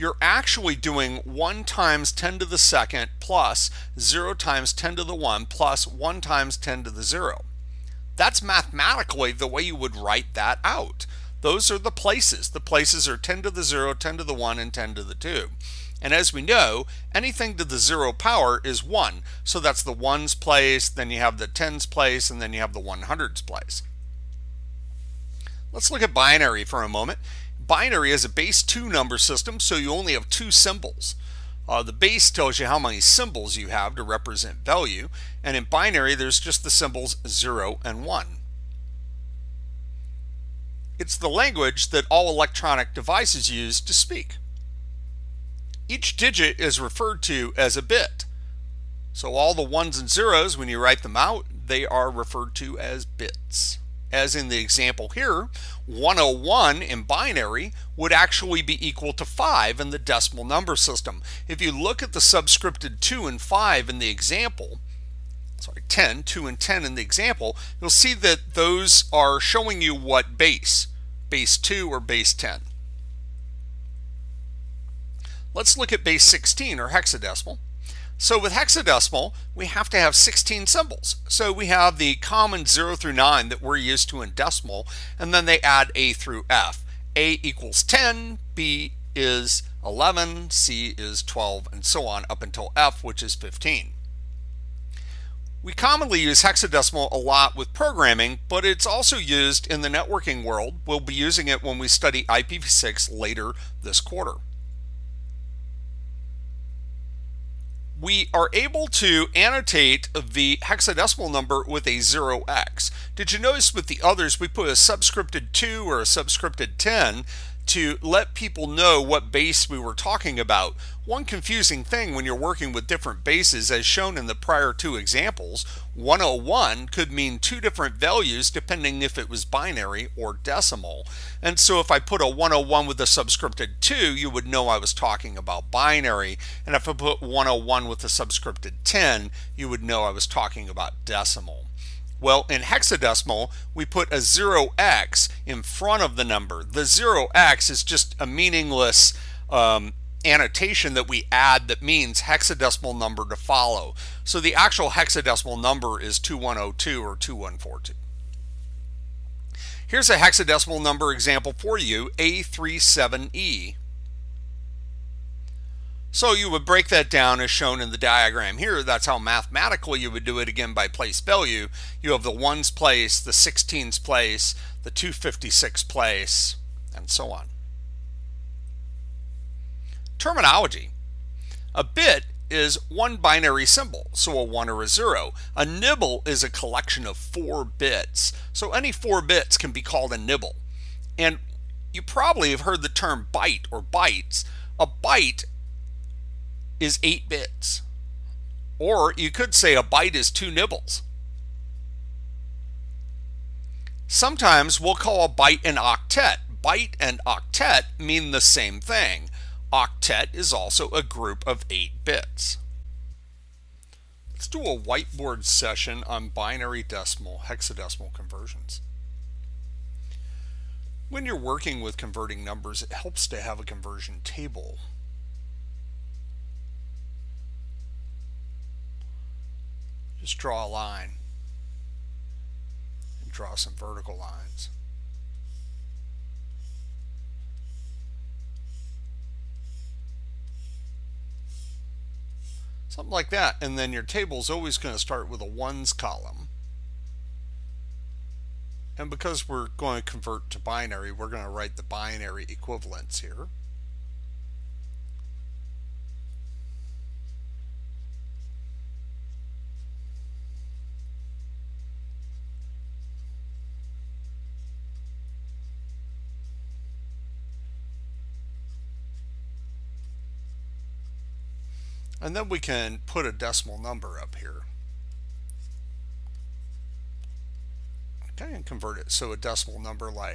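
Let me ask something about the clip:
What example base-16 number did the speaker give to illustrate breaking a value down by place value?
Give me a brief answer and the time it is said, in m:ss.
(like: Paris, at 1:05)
A37E, at 2:42.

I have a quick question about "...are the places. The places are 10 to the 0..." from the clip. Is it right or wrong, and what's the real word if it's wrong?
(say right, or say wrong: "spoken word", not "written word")
right.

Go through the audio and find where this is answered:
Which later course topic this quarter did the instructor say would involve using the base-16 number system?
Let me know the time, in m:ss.
1:42.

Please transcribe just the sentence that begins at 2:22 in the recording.
Well, in hexadecimal, we put a 0x in front of the number.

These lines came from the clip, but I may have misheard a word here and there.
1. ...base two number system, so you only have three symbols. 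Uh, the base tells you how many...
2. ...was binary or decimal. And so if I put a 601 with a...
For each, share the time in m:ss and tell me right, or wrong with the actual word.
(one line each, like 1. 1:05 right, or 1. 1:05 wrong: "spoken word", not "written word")
1. 0:28 wrong: "two", not "three"
2. 2:09 wrong: "101", not "601".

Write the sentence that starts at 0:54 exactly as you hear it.
As in the example here, 101 in binary would actually be equal to 5 in the decimal number system.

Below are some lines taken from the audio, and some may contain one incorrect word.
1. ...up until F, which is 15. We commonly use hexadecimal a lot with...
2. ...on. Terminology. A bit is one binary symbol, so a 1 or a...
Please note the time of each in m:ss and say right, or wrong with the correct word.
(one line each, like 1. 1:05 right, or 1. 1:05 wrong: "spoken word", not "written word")
1. 1:32 right
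2. 2:57 right.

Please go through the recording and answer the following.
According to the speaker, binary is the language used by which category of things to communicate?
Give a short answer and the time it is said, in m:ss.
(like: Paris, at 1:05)
All electronic devices, at 0:42.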